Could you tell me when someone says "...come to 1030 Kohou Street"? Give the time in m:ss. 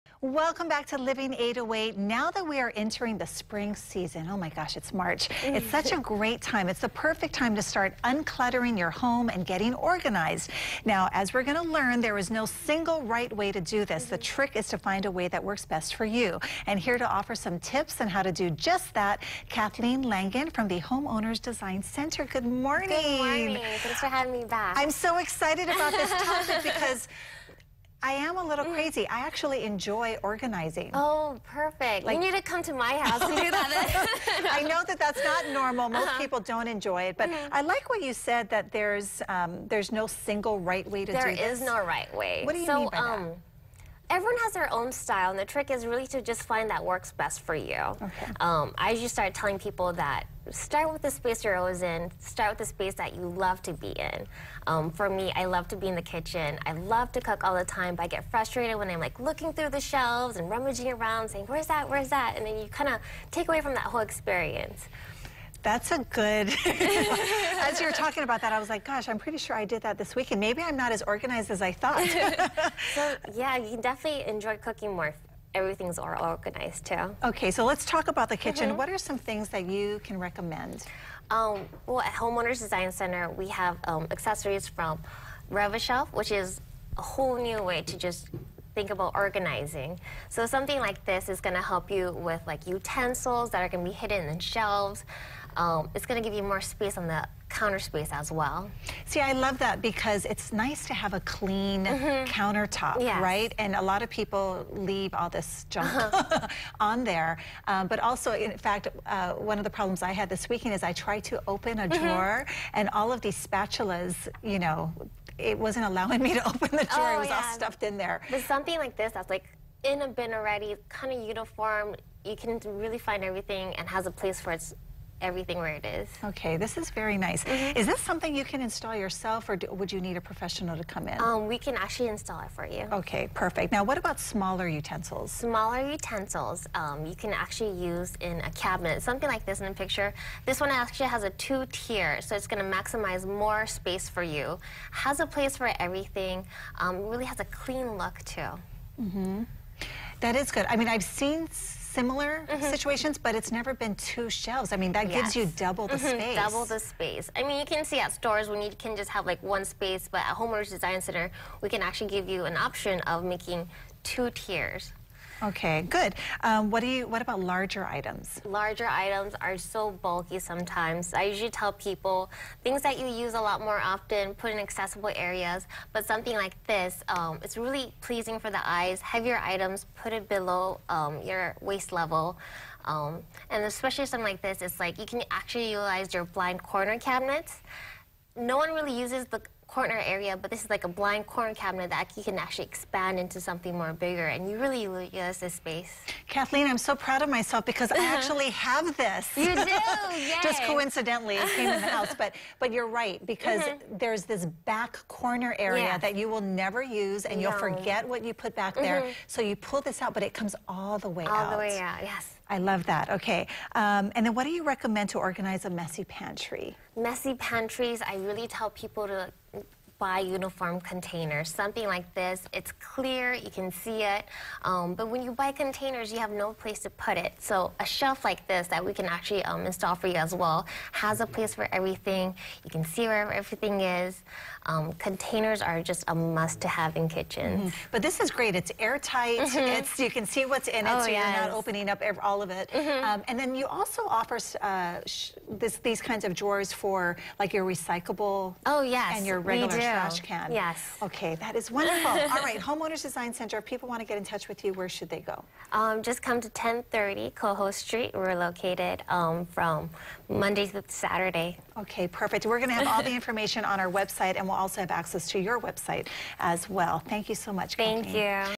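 4:16.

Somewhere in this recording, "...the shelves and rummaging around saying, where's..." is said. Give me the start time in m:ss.
0:59.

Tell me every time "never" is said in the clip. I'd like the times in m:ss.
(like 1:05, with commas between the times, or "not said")
2:33, 3:26.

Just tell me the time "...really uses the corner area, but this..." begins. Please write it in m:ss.
3:08.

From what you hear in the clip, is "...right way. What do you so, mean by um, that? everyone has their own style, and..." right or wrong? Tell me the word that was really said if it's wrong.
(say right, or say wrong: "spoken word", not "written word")
right.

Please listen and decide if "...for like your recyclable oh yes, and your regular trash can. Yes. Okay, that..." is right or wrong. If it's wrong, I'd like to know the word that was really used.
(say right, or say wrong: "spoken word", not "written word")
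right.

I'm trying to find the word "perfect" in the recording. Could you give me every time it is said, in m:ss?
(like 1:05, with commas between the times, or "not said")
0:06, 0:31, 2:13, 4:22.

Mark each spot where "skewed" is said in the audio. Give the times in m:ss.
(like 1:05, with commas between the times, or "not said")
not said.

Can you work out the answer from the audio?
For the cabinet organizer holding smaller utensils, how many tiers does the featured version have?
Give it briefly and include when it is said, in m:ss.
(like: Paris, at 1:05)
2, at 2:21.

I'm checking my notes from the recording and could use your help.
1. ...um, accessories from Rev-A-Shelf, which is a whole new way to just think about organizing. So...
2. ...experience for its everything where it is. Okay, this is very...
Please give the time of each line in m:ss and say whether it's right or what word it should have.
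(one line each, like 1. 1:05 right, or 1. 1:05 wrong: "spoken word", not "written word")
1. 1:23 right
2. 2:04 wrong: "place", not "experience".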